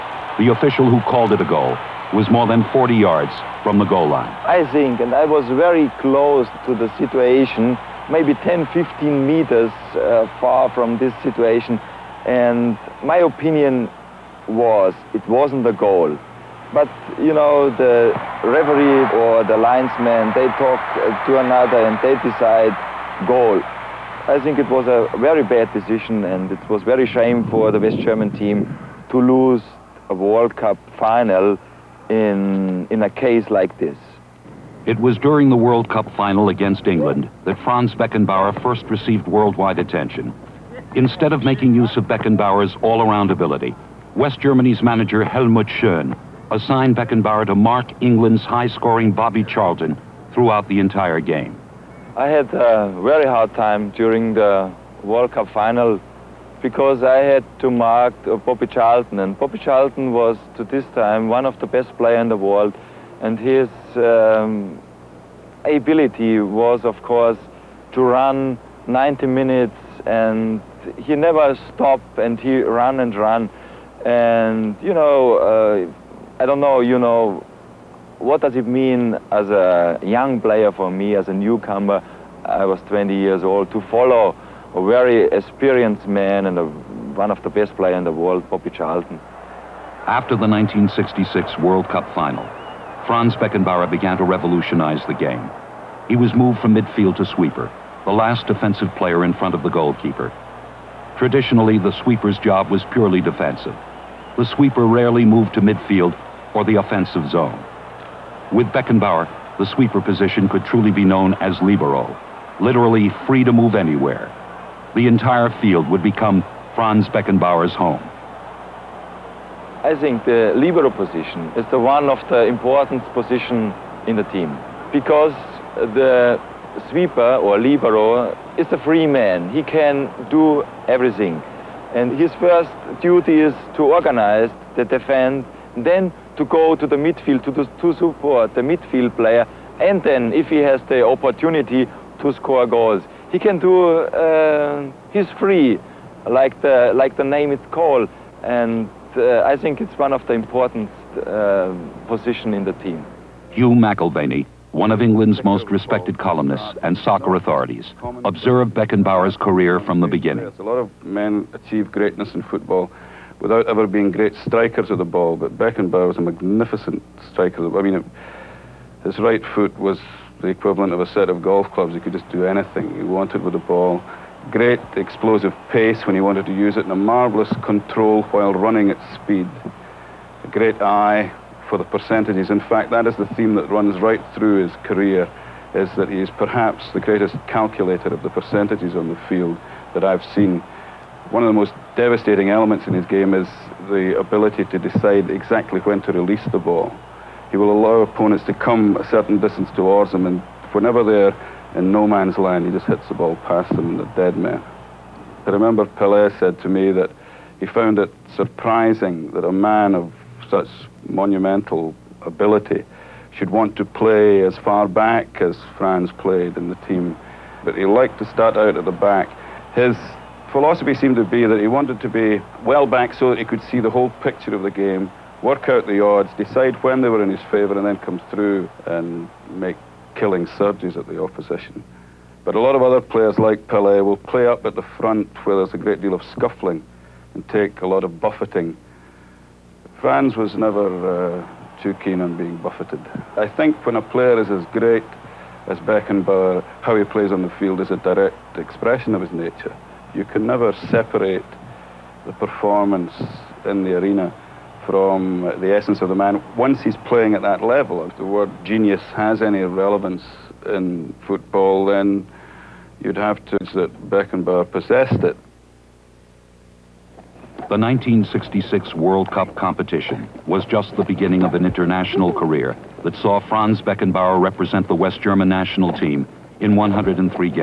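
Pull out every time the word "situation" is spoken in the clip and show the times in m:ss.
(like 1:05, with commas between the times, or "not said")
0:06, 0:11.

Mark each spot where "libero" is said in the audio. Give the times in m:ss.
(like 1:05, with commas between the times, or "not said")
1:51, 2:00, 2:07.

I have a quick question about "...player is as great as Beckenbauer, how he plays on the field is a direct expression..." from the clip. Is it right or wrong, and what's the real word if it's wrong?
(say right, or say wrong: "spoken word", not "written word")
right.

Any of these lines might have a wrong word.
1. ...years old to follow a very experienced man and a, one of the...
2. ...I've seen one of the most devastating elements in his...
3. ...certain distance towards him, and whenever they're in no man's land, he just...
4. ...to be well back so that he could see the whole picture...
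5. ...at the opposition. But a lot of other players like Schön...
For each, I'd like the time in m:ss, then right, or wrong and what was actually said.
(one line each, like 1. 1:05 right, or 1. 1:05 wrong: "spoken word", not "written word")
1. 1:23 right
2. 3:10 right
3. 3:19 right
4. 3:41 right
5. 3:50 wrong: "Pelé", not "Schön".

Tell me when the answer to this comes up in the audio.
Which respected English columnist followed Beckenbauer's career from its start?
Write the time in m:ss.
2:33.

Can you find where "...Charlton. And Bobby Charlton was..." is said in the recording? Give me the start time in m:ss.
0:58.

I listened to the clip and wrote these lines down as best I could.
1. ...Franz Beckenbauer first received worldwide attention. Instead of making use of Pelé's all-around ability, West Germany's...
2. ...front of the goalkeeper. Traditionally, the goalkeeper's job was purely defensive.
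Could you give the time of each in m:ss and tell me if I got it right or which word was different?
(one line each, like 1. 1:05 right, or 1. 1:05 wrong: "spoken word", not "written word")
1. 0:37 wrong: "Beckenbauer", not "Pelé"
2. 1:39 wrong: "sweeper", not "goalkeeper".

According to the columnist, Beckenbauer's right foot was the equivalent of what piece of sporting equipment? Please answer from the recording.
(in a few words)
A set of golf clubs.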